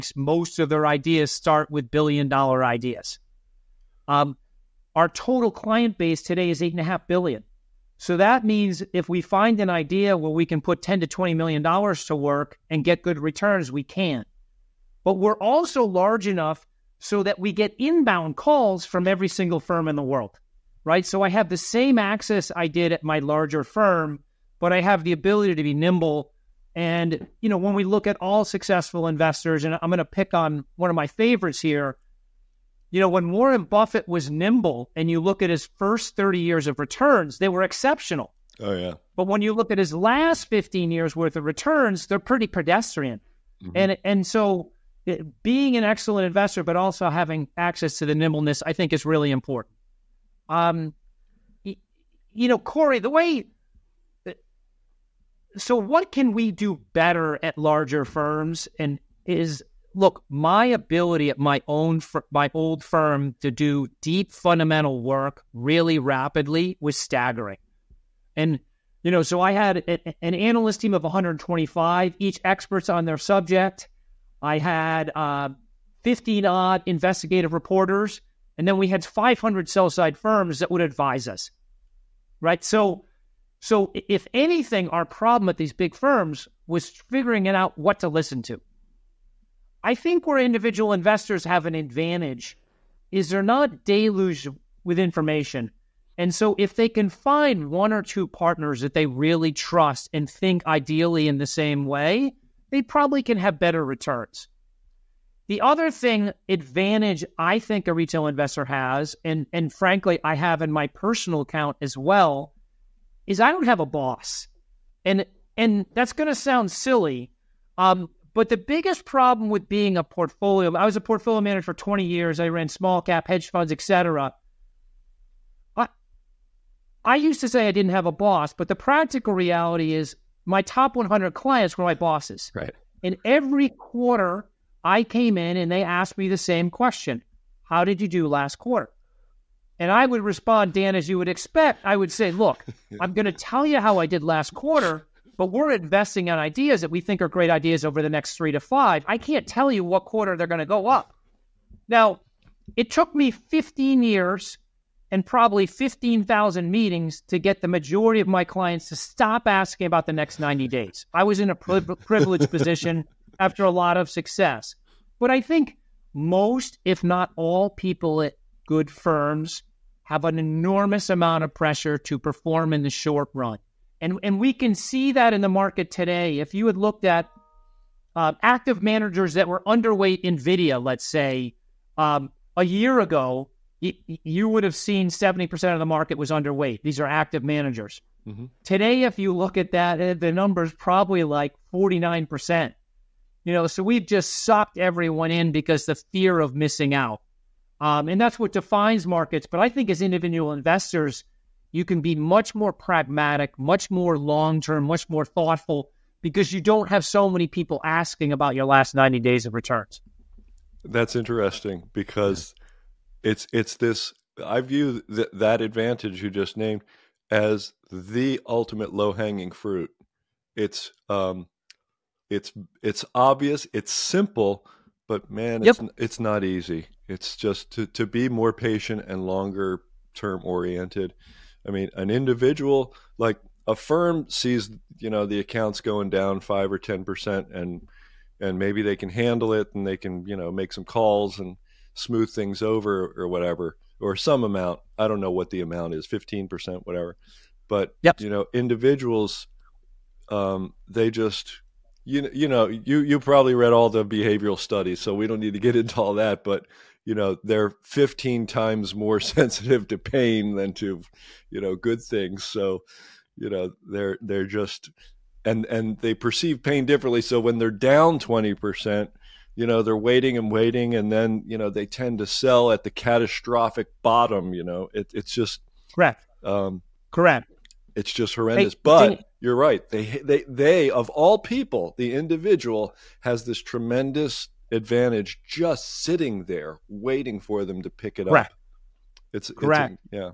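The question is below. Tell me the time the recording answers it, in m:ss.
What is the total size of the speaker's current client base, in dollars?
0:06.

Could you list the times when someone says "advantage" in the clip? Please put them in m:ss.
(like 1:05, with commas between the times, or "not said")
1:31, 1:46, 3:35, 4:44.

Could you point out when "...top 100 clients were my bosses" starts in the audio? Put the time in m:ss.
2:10.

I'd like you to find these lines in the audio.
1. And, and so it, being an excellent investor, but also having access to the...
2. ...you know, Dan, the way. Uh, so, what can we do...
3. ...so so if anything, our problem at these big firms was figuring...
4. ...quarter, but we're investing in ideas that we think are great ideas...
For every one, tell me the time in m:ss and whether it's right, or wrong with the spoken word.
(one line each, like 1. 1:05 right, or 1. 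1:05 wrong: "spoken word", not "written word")
1. 0:43 right
2. 0:51 wrong: "Corey", not "Dan"
3. 1:22 right
4. 2:24 right.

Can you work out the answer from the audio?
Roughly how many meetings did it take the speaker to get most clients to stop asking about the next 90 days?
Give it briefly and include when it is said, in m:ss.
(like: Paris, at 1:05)
15,000, at 2:35.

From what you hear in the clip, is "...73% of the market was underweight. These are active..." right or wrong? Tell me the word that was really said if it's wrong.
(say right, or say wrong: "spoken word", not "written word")
wrong: "70", not "73".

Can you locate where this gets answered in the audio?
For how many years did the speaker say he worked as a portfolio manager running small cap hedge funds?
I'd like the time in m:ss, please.
2:01.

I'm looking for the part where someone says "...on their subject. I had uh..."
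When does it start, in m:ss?
1:12.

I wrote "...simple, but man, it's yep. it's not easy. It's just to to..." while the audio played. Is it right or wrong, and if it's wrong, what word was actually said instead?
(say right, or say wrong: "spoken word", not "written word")
right.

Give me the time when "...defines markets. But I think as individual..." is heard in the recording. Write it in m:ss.
3:18.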